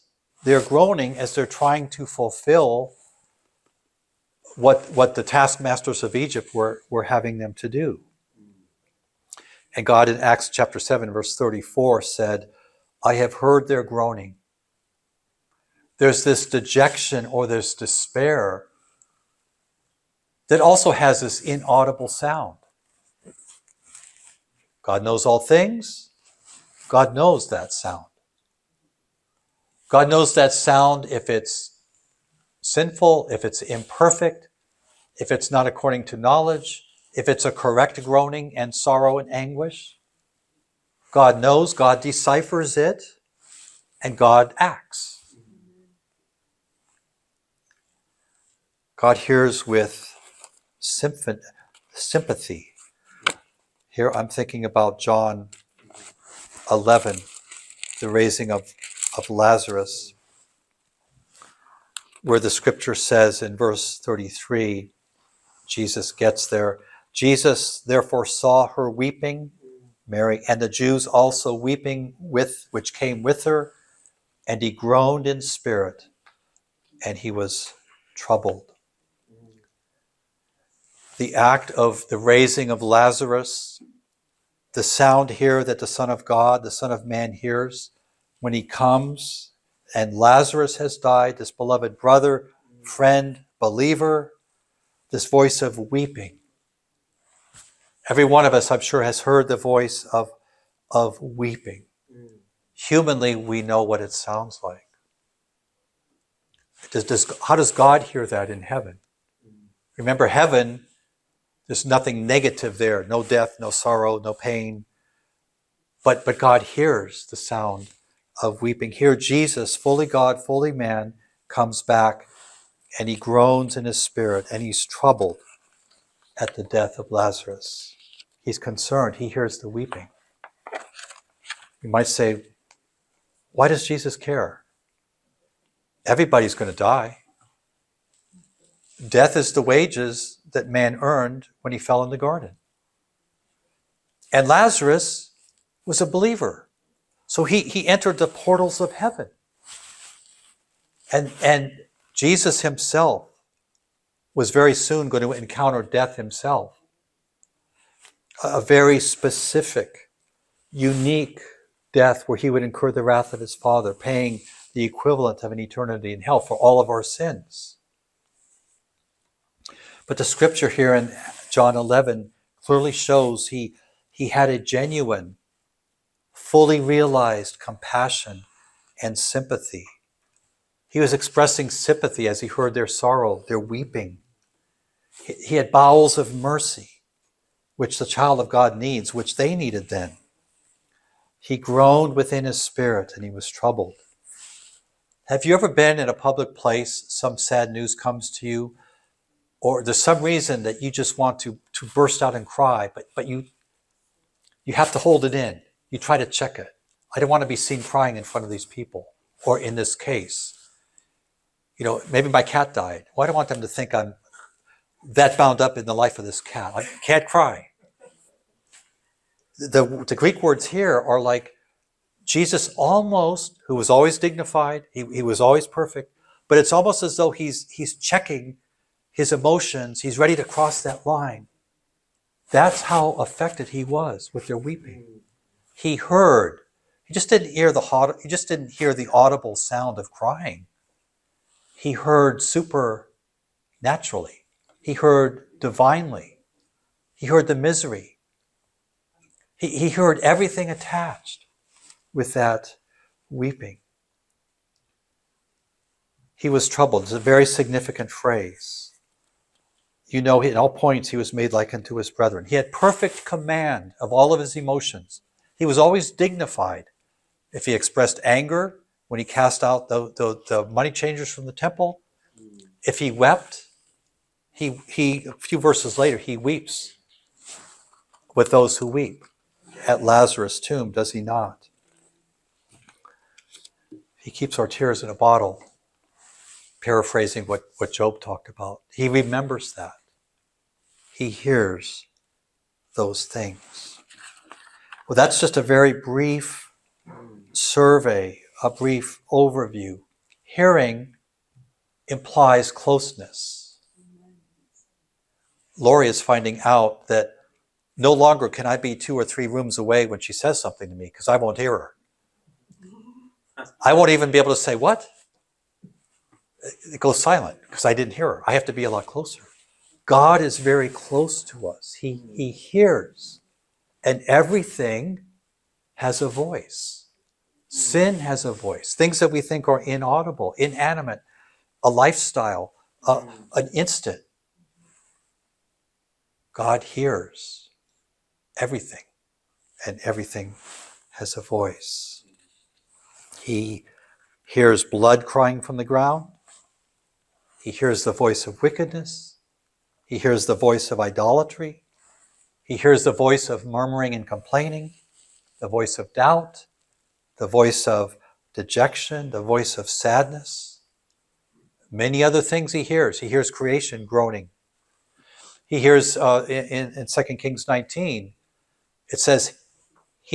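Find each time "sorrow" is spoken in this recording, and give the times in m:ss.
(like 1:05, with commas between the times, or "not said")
0:38, 1:53, 3:02.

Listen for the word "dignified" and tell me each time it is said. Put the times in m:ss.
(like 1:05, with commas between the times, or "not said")
3:44, 4:26.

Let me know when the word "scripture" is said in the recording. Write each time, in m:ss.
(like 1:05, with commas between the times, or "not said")
1:02, 2:50.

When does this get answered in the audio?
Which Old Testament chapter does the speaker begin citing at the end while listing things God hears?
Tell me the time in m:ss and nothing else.
6:07.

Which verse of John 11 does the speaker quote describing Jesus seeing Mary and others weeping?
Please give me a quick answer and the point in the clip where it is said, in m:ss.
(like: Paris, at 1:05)
Verse 33, at 1:03.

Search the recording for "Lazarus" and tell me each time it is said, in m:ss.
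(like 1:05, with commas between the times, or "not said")
0:59, 1:22, 1:30, 2:07, 2:24, 4:40.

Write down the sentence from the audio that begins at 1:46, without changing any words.
Does, does, how does God hear that in heaven?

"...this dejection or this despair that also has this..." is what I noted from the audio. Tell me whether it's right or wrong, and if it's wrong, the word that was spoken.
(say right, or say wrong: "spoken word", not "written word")
right.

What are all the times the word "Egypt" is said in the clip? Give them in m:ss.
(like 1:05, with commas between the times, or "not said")
0:06.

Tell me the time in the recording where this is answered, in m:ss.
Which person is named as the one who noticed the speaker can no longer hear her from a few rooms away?
5:05.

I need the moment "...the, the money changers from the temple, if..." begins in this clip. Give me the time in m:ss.
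4:30.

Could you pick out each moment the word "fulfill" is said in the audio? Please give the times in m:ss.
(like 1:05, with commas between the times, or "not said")
0:02.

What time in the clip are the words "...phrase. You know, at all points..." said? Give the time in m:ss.
4:18.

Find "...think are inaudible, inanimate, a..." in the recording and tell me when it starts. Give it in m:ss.
5:29.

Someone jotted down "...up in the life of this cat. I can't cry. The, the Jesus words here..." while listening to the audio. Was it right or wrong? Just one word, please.
wrong.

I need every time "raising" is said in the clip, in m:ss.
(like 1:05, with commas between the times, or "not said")
0:58, 1:22.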